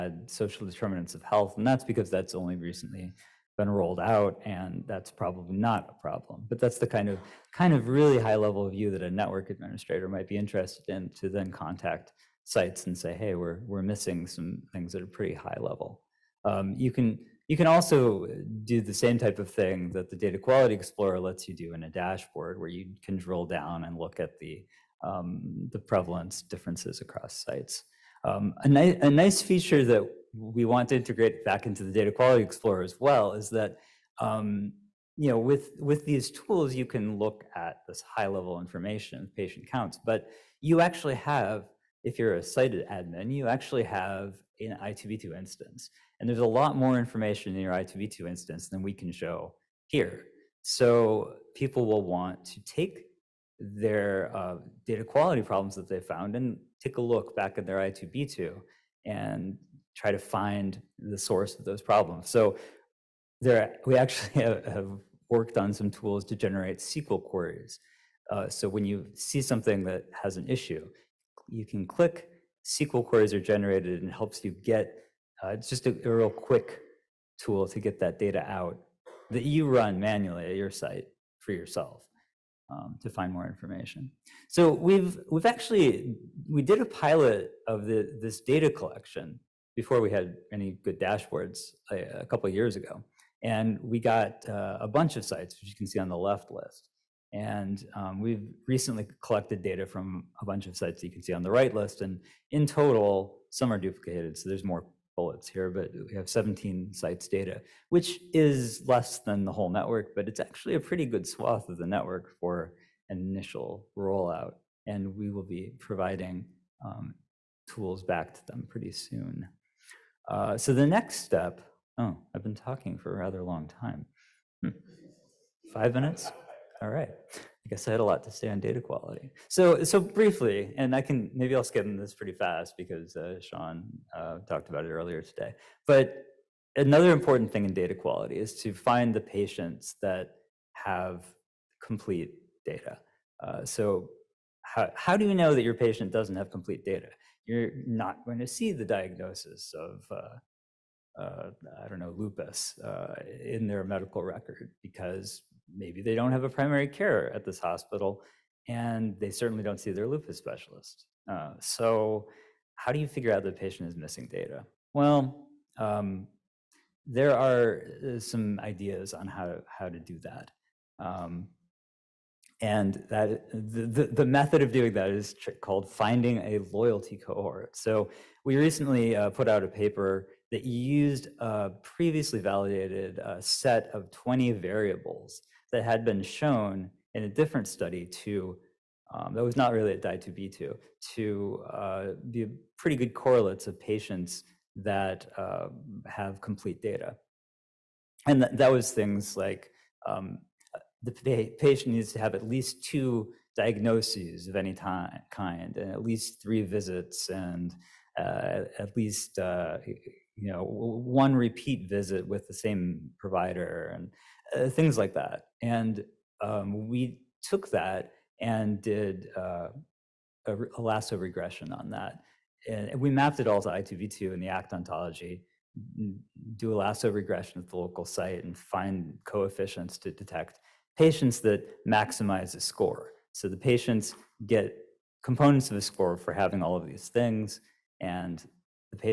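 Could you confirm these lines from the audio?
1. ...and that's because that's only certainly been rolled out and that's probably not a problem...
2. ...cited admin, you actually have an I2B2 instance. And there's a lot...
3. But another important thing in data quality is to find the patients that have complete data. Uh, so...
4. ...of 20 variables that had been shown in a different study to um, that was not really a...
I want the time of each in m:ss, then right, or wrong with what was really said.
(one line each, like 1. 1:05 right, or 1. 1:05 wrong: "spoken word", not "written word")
1. 0:01 wrong: "recently", not "certainly"
2. 0:42 right
3. 2:15 right
4. 3:03 right.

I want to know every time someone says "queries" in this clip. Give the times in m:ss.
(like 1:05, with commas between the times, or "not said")
1:07, 1:13.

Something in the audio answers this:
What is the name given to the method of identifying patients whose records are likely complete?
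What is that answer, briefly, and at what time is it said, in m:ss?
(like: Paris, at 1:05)
loyalty cohort, at 2:56.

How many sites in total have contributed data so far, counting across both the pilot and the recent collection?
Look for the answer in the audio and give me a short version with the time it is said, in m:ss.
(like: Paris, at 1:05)
17, at 1:46.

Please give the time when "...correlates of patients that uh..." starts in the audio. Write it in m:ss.
3:13.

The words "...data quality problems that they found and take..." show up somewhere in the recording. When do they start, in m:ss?
0:54.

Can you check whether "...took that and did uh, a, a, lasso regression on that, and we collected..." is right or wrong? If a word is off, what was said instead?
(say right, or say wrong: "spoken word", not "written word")
wrong: "mapped", not "collected".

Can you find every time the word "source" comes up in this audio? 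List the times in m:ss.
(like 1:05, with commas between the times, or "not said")
1:01.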